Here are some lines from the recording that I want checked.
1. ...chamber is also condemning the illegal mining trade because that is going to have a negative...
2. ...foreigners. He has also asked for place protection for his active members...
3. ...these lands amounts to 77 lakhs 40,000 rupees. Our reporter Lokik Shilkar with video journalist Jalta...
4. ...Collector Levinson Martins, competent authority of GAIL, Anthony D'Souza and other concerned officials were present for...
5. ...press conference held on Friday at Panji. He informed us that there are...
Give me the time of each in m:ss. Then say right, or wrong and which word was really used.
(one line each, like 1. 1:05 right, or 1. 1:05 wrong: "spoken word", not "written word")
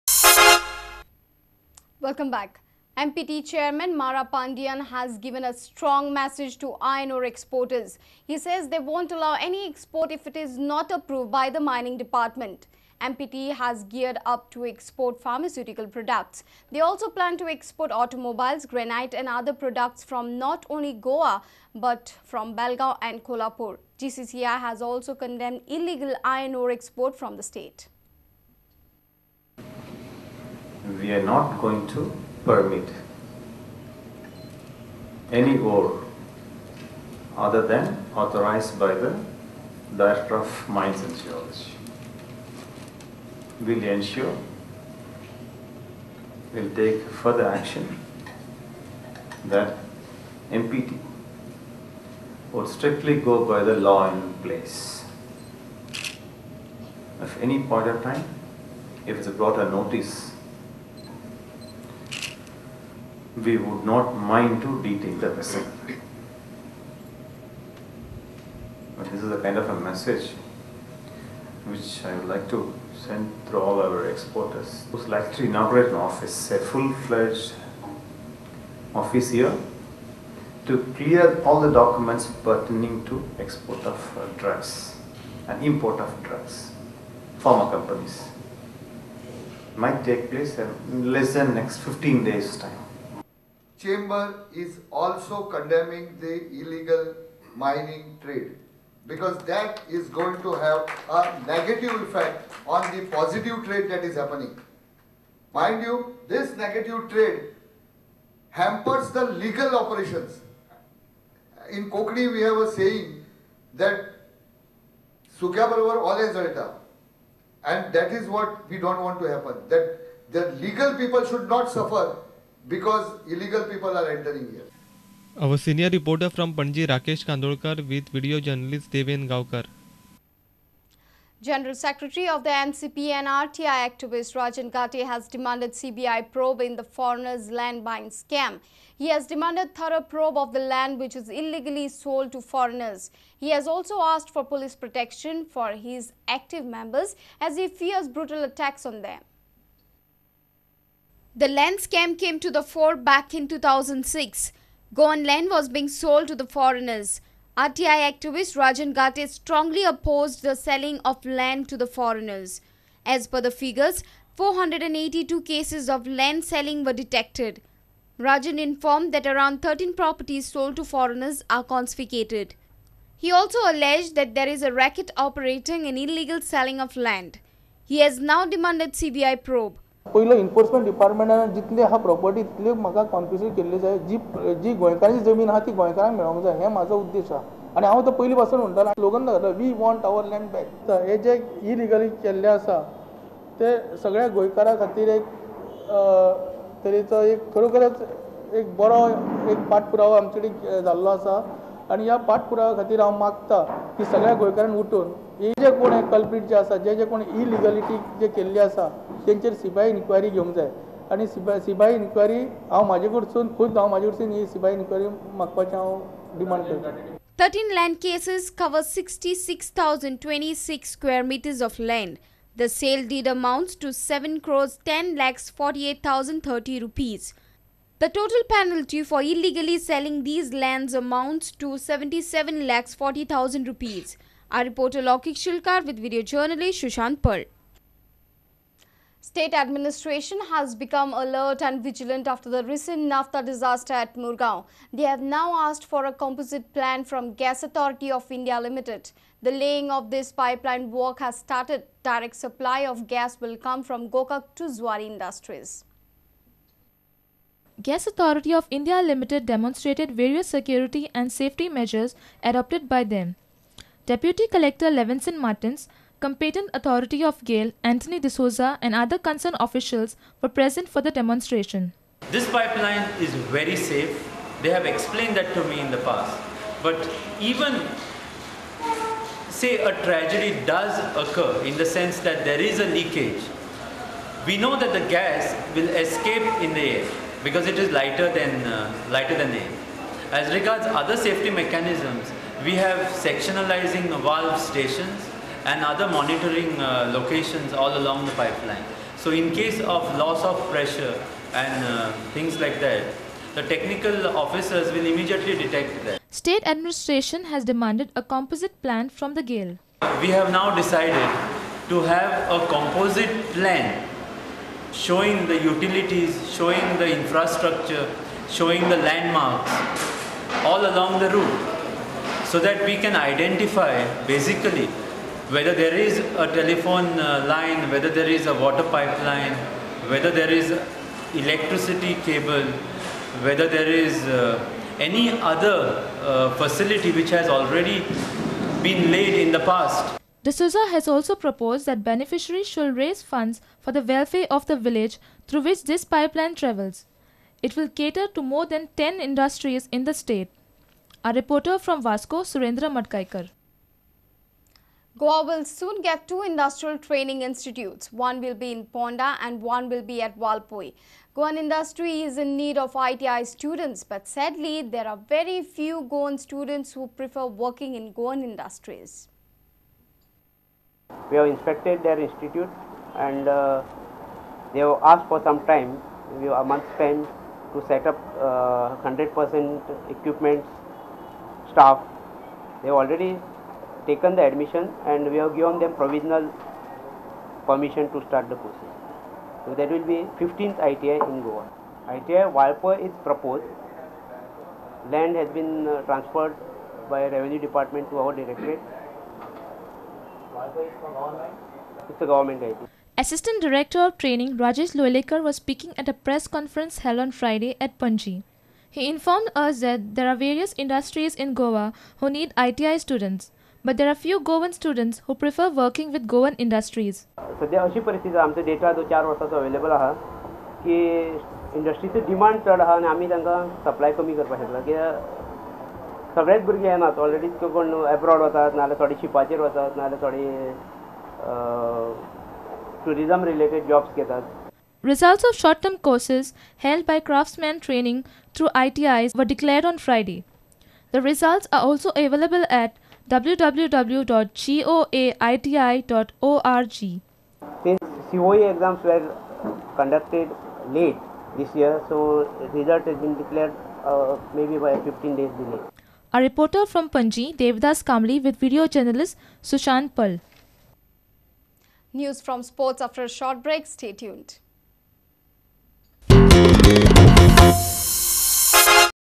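1. 1:33 right
2. 2:22 wrong: "police", not "place"
3. 3:50 wrong: "Shushant", not "Jalta"
4. 4:24 right
5. 6:46 right.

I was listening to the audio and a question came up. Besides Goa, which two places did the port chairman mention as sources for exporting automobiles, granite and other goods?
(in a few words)
Belgaum and Kolhapur.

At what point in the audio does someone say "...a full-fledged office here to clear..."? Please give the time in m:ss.
1:16.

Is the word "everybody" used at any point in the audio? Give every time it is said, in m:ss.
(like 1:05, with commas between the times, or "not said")
not said.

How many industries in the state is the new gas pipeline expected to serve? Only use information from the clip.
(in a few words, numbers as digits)
More than 10.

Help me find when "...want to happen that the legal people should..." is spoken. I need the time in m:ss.
1:59.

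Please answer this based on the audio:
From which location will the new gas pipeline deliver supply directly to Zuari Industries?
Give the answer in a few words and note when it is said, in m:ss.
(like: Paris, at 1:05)
Gokak, at 4:14.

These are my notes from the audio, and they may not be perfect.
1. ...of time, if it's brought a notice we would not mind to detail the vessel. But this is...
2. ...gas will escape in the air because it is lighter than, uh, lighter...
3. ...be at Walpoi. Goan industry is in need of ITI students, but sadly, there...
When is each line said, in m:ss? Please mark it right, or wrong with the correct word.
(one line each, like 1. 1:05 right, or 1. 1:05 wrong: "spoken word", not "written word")
1. 0:57 right
2. 4:45 right
3. 6:00 right.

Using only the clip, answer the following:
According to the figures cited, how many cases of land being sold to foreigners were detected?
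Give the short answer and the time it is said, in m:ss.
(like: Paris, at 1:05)
482, at 2:44.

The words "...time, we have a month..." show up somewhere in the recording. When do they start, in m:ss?
6:15.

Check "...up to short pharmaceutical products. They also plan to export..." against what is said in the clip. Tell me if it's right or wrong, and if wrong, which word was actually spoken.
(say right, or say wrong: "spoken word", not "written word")
wrong: "export", not "short".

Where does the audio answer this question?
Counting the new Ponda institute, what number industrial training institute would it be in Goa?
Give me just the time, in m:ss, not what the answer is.
6:30.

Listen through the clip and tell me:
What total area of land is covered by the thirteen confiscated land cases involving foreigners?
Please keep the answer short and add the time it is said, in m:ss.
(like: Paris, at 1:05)
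66,026 square meters, at 3:38.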